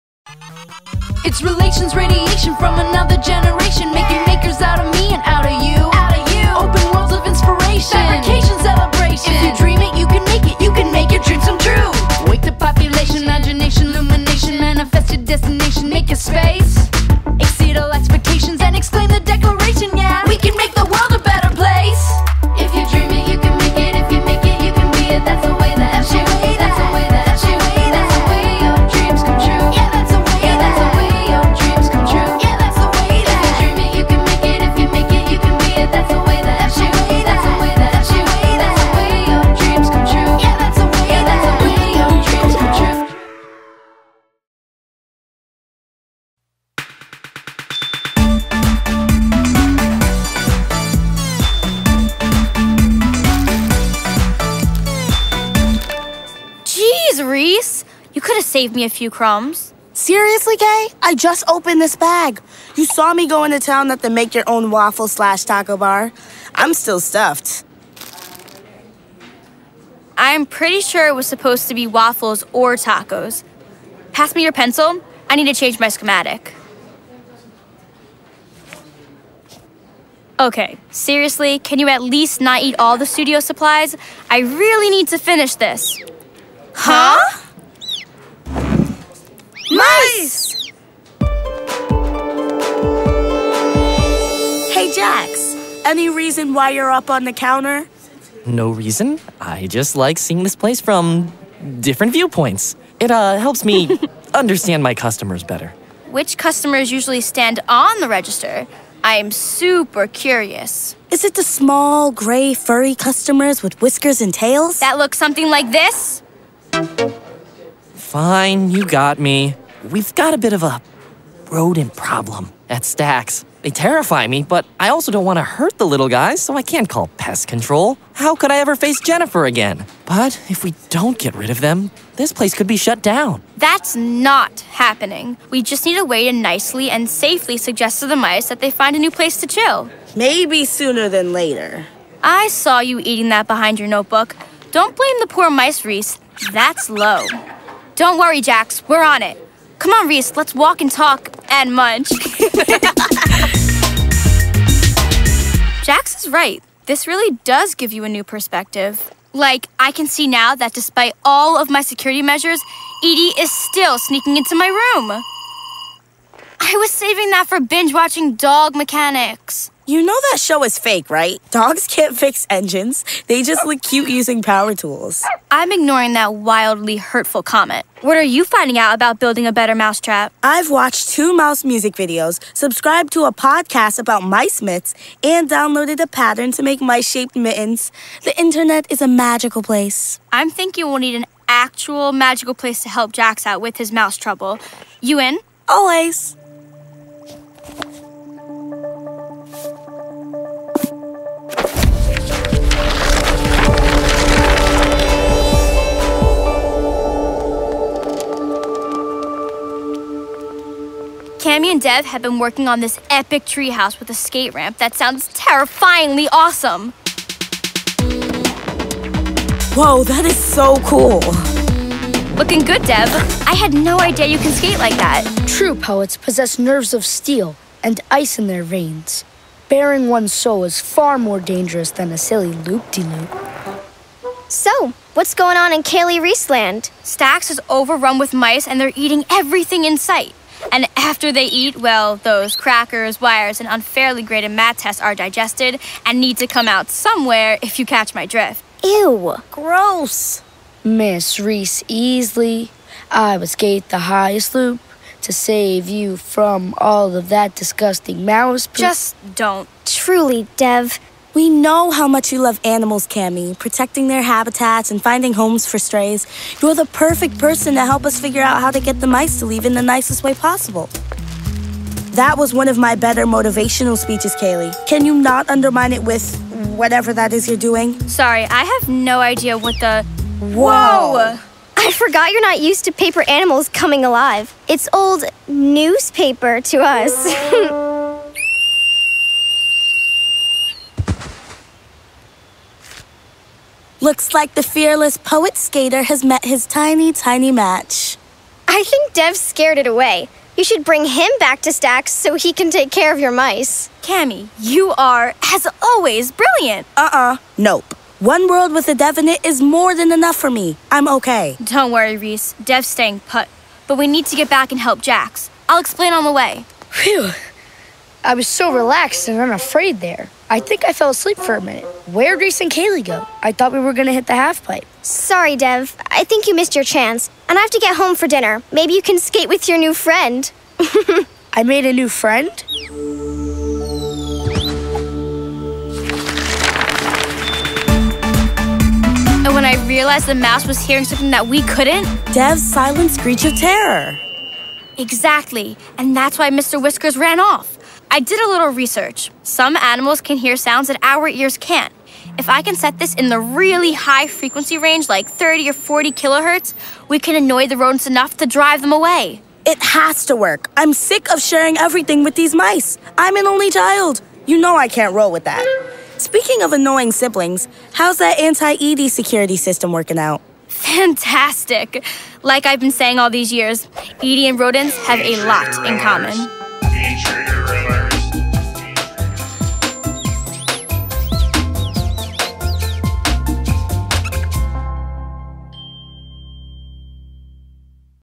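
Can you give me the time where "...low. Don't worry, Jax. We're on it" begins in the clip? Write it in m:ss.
2:26.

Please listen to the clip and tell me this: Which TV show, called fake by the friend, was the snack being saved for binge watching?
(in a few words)
Dog Mechanics.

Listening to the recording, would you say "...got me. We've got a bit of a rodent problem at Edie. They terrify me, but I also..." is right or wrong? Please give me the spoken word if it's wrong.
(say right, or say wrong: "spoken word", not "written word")
wrong: "Stacks", not "Edie".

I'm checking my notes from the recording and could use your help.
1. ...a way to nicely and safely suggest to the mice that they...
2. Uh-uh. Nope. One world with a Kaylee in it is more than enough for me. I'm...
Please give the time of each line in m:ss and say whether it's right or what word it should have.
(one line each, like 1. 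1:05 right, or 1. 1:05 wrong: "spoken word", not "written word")
1. 2:15 right
2. 5:06 wrong: "Dev", not "Kaylee".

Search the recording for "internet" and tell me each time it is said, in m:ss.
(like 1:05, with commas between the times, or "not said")
3:08.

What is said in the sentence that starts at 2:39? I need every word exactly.
Like, I can see now that despite all of my security measures, Edie is still sneaking into my room.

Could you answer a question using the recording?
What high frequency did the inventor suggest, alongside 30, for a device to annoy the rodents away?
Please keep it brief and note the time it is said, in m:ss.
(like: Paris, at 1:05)
40 kilohertz, at 5:55.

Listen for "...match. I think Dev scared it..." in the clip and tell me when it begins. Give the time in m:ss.
4:57.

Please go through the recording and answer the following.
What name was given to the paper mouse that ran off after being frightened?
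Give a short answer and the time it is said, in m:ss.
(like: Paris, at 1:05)
Mr. Whiskers, at 5:46.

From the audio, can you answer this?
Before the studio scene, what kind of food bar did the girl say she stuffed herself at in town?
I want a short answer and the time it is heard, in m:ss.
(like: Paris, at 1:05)
Make your own waffle slash taco bar, at 1:04.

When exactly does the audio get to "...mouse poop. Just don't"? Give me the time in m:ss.
4:18.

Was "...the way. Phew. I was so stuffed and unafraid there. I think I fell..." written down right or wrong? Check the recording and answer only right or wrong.
wrong.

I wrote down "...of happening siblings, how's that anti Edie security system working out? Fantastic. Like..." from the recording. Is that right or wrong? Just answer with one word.
wrong.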